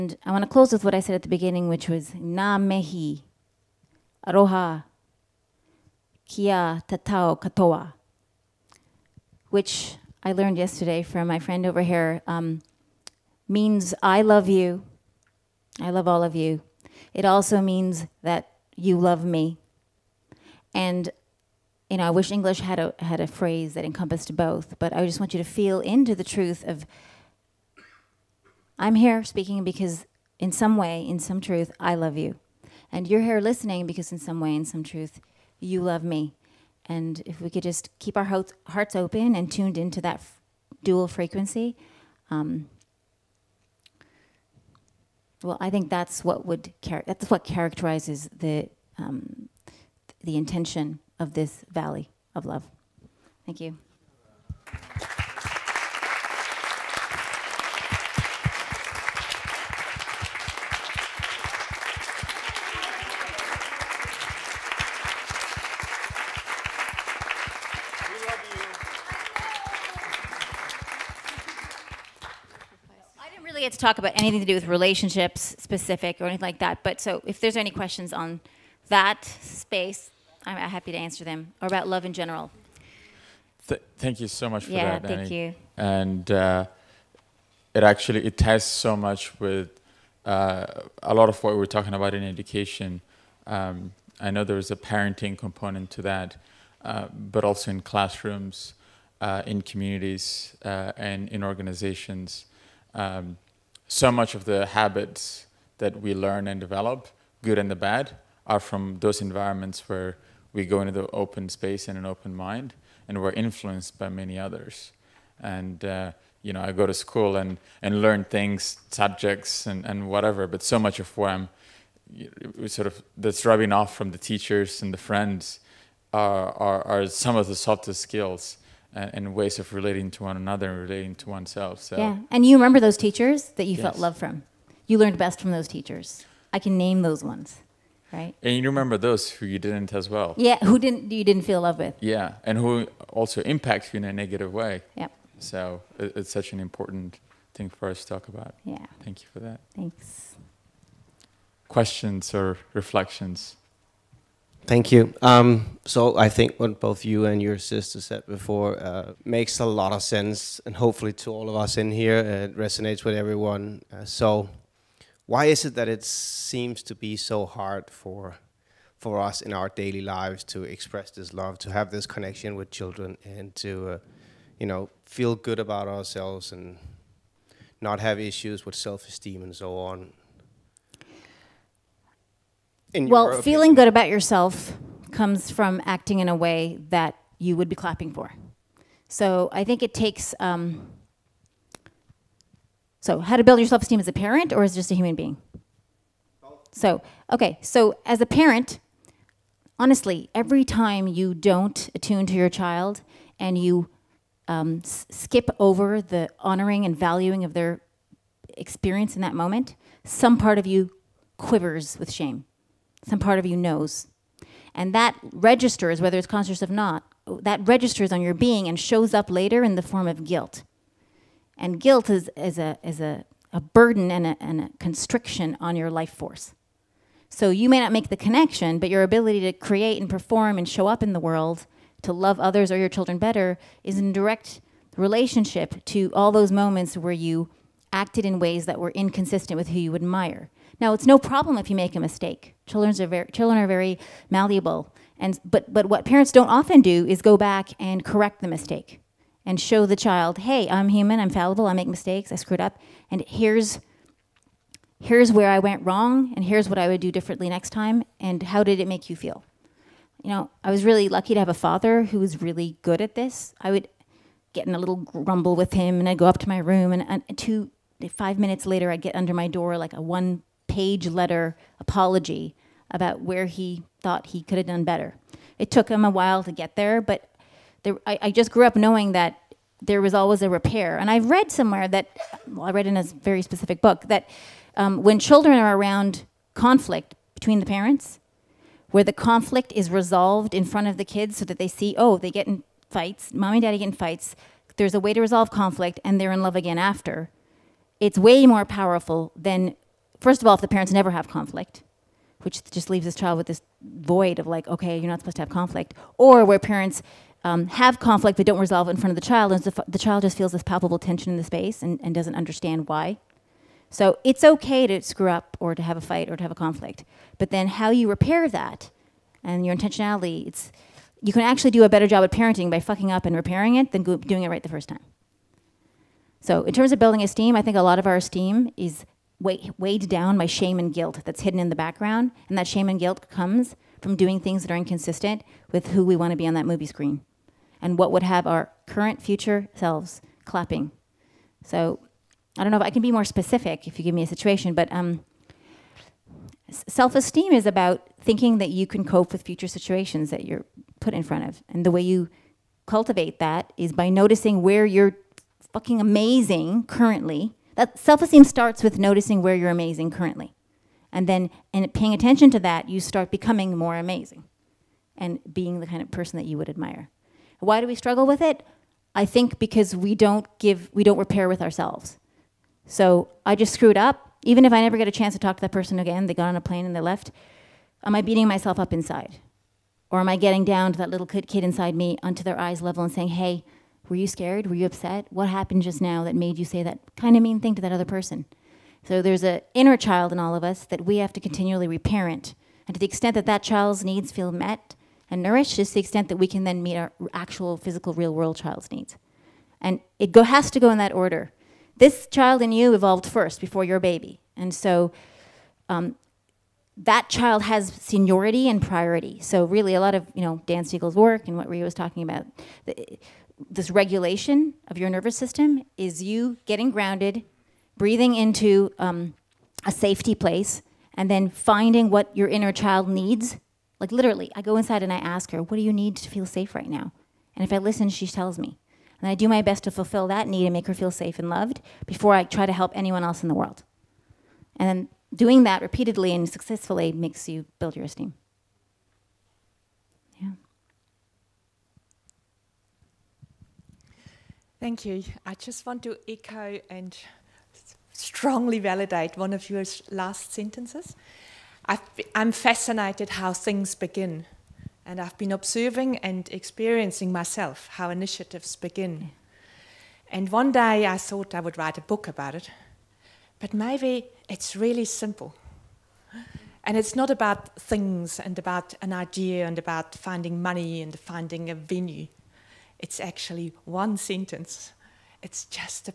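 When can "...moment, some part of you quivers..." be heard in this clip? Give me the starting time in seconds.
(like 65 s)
209 s.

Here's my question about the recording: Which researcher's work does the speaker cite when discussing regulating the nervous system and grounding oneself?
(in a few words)
Dan Siegel.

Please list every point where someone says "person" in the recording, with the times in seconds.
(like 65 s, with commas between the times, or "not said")
366 s, 375 s, 388 s.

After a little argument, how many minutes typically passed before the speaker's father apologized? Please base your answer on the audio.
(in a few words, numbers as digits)
2 to 5 minutes.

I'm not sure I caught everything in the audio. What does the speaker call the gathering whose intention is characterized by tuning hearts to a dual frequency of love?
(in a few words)
valley of love.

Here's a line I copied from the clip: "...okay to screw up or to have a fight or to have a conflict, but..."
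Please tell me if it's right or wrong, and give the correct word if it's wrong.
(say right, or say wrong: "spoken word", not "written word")
right.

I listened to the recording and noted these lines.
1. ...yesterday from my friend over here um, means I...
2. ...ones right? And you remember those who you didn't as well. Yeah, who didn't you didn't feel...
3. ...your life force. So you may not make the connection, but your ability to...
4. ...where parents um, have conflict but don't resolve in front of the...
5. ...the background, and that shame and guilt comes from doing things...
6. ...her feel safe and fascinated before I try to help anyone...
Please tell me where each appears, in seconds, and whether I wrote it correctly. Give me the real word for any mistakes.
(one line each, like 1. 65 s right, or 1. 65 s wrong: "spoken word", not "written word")
1. 10 s right
2. 137 s right
3. 225 s right
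4. 306 s right
5. 331 s right
6. 430 s wrong: "loved", not "fascinated".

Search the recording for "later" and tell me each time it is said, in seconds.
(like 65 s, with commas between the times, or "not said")
219 s, 268 s.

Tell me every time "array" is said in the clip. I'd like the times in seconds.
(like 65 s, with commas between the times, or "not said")
not said.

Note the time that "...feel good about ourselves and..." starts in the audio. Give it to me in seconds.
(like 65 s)
175 s.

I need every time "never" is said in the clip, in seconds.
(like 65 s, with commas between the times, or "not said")
300 s, 374 s.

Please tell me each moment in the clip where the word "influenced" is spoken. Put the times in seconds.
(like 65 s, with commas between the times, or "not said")
113 s.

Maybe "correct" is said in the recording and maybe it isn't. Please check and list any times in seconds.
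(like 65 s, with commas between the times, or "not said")
248 s.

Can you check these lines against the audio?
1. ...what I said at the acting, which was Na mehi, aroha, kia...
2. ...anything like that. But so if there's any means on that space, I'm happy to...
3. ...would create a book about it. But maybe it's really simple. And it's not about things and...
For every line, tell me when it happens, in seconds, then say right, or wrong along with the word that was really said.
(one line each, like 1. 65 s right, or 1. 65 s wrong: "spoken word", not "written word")
1. 0 s wrong: "beginning", not "acting"
2. 76 s wrong: "questions", not "means"
3. 461 s wrong: "write", not "create".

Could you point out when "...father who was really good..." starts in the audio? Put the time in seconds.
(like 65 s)
261 s.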